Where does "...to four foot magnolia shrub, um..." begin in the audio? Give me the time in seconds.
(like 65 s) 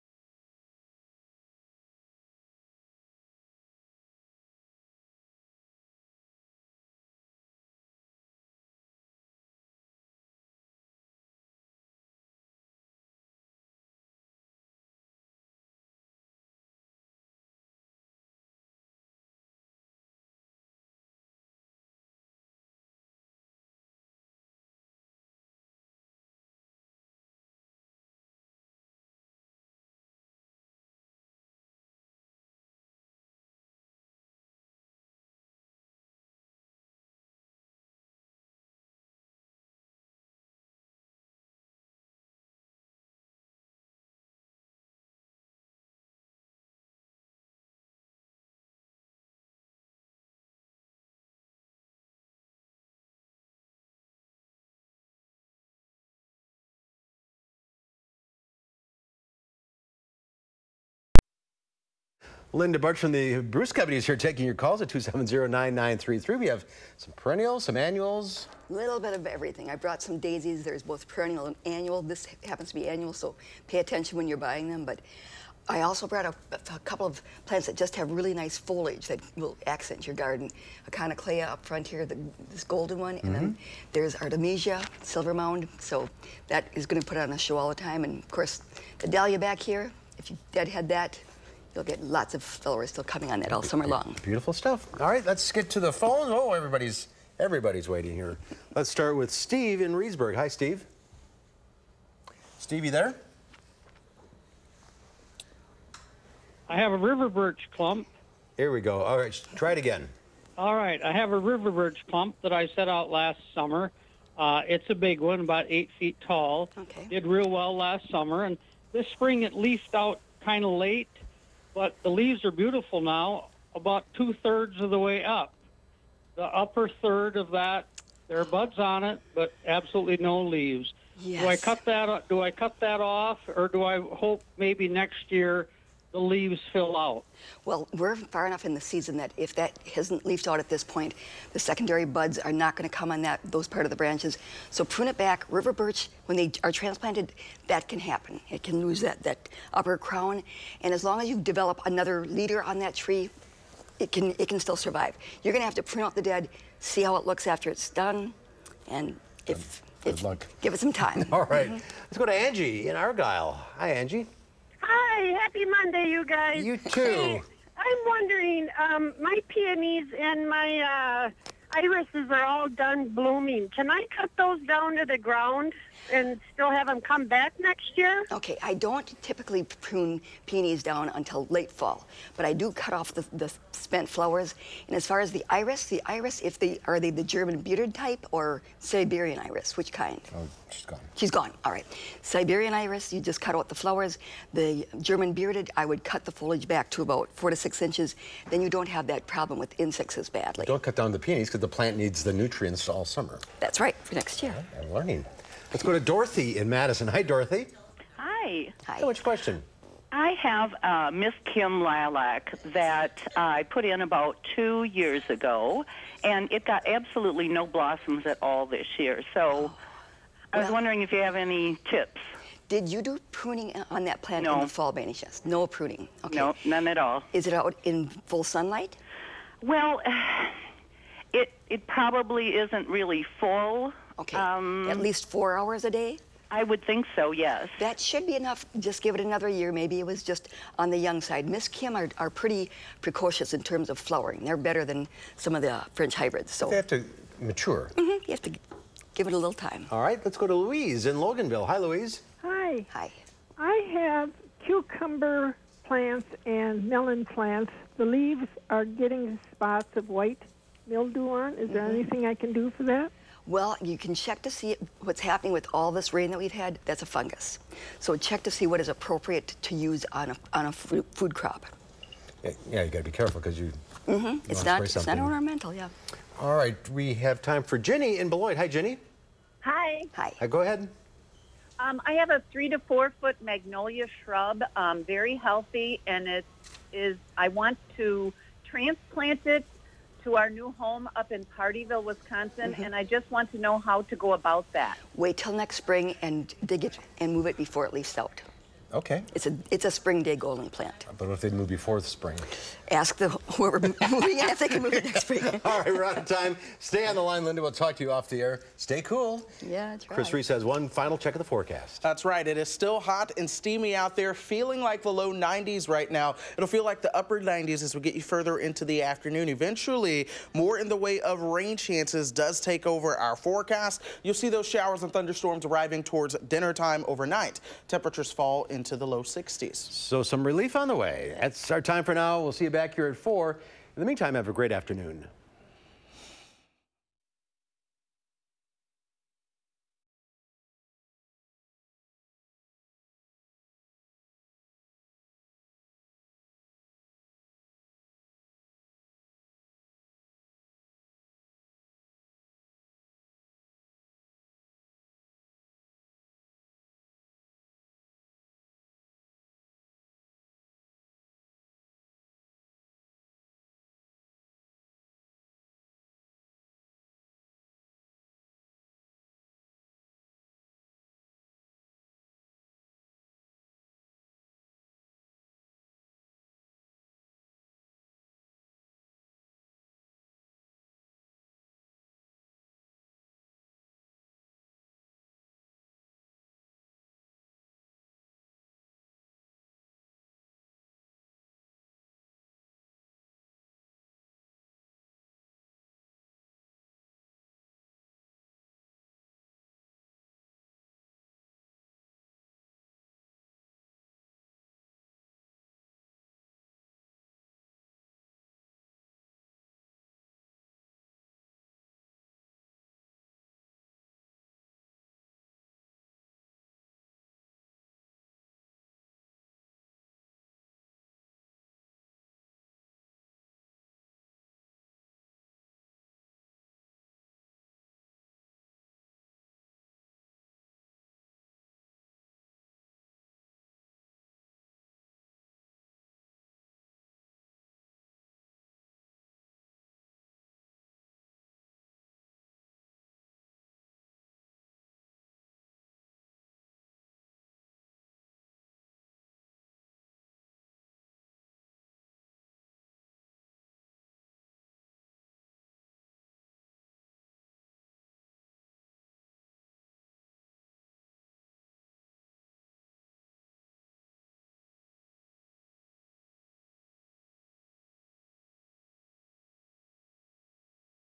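282 s.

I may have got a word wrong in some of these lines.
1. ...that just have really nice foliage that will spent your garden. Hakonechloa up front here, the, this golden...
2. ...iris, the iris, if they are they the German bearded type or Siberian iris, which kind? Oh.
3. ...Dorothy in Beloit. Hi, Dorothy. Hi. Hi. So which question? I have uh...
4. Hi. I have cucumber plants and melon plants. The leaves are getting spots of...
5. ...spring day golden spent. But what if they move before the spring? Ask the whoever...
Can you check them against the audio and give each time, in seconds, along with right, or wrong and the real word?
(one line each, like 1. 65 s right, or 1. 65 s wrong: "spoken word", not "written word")
1. 77 s wrong: "accent", not "spent"
2. 185 s right
3. 205 s wrong: "Madison", not "Beloit"
4. 252 s right
5. 299 s wrong: "plant", not "spent".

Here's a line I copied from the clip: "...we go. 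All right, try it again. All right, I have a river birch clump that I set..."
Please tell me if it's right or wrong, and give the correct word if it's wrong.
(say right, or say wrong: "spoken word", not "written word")
right.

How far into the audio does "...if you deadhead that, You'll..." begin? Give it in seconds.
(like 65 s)
90 s.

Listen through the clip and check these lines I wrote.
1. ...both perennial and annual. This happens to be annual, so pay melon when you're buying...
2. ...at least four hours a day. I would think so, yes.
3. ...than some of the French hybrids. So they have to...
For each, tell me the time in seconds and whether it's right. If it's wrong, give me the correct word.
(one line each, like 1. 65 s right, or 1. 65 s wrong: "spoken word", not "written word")
1. 70 s wrong: "attention", not "melon"
2. 234 s right
3. 244 s right.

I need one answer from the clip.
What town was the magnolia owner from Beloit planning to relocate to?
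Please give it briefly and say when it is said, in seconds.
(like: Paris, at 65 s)
Pardeeville, at 291 s.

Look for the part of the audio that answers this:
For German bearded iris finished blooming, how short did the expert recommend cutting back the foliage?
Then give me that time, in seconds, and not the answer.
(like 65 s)
197 s.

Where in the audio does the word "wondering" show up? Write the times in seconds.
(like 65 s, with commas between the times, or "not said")
168 s, 220 s.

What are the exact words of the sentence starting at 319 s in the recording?
Eventually, more in the way of rain chances does take over our forecast.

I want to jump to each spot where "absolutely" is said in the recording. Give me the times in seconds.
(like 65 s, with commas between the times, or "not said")
129 s, 216 s.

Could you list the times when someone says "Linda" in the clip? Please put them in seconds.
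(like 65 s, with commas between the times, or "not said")
62 s, 307 s.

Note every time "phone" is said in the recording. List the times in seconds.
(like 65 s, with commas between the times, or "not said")
95 s.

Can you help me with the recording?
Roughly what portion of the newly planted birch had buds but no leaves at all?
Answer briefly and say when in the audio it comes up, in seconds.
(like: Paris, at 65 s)
Upper third, at 126 s.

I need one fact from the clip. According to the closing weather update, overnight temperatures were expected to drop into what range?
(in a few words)
Low 60s.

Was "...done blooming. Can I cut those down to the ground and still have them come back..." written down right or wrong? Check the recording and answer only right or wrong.
right.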